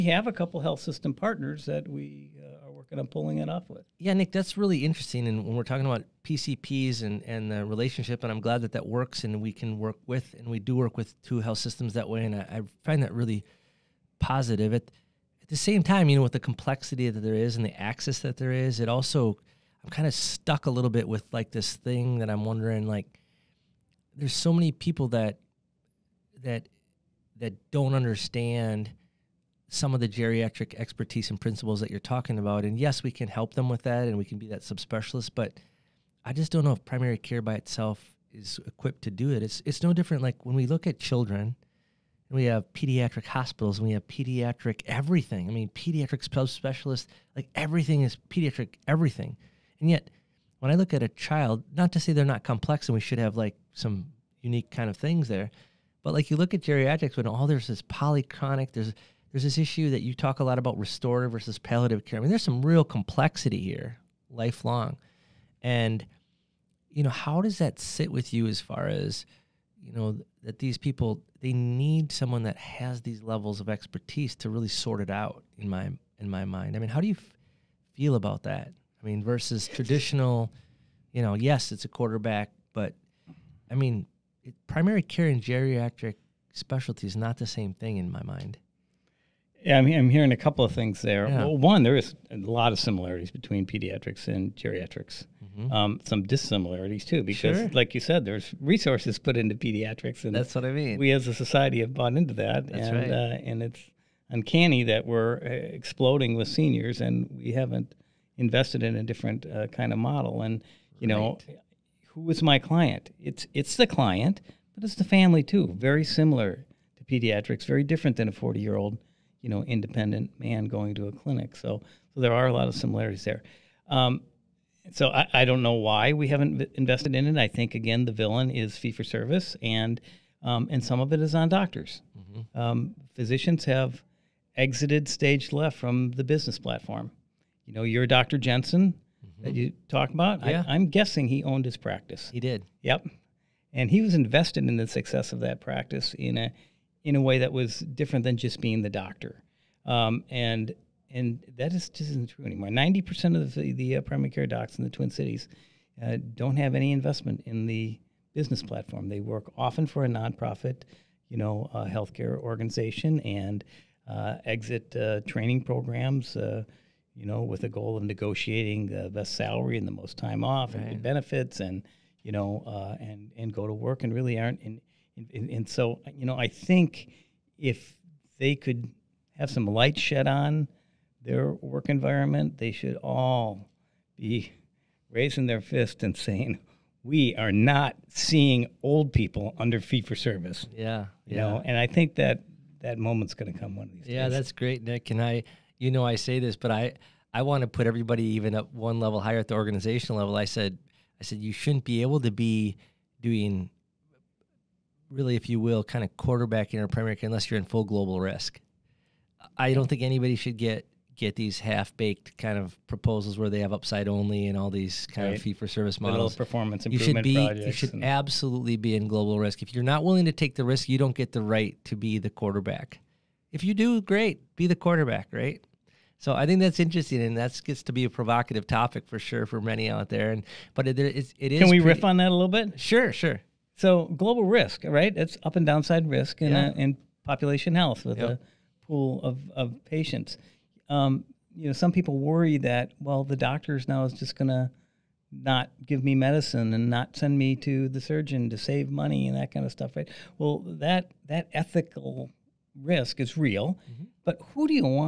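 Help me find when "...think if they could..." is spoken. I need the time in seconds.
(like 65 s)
176 s.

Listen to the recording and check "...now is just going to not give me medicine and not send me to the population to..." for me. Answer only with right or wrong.
wrong.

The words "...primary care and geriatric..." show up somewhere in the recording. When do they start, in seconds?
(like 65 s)
84 s.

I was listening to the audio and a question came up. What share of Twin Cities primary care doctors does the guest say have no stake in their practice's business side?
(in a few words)
90 percent.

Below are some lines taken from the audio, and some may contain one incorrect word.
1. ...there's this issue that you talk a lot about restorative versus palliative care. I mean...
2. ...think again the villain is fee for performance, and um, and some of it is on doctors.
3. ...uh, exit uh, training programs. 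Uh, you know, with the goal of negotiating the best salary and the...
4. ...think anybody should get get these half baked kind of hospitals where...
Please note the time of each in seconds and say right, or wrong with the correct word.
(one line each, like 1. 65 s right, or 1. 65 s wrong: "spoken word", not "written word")
1. 59 s right
2. 127 s wrong: "service", not "performance"
3. 164 s right
4. 209 s wrong: "proposals", not "hospitals".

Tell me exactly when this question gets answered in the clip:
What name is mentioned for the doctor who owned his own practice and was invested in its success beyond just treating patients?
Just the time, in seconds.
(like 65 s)
138 s.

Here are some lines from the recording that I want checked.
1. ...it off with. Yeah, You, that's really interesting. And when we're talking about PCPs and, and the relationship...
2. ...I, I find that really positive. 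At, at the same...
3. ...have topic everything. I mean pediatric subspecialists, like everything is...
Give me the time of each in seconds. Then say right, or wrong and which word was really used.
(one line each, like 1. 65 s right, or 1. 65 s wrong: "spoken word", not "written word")
1. 3 s wrong: "Nick", not "You"
2. 12 s right
3. 43 s wrong: "pediatric", not "topic".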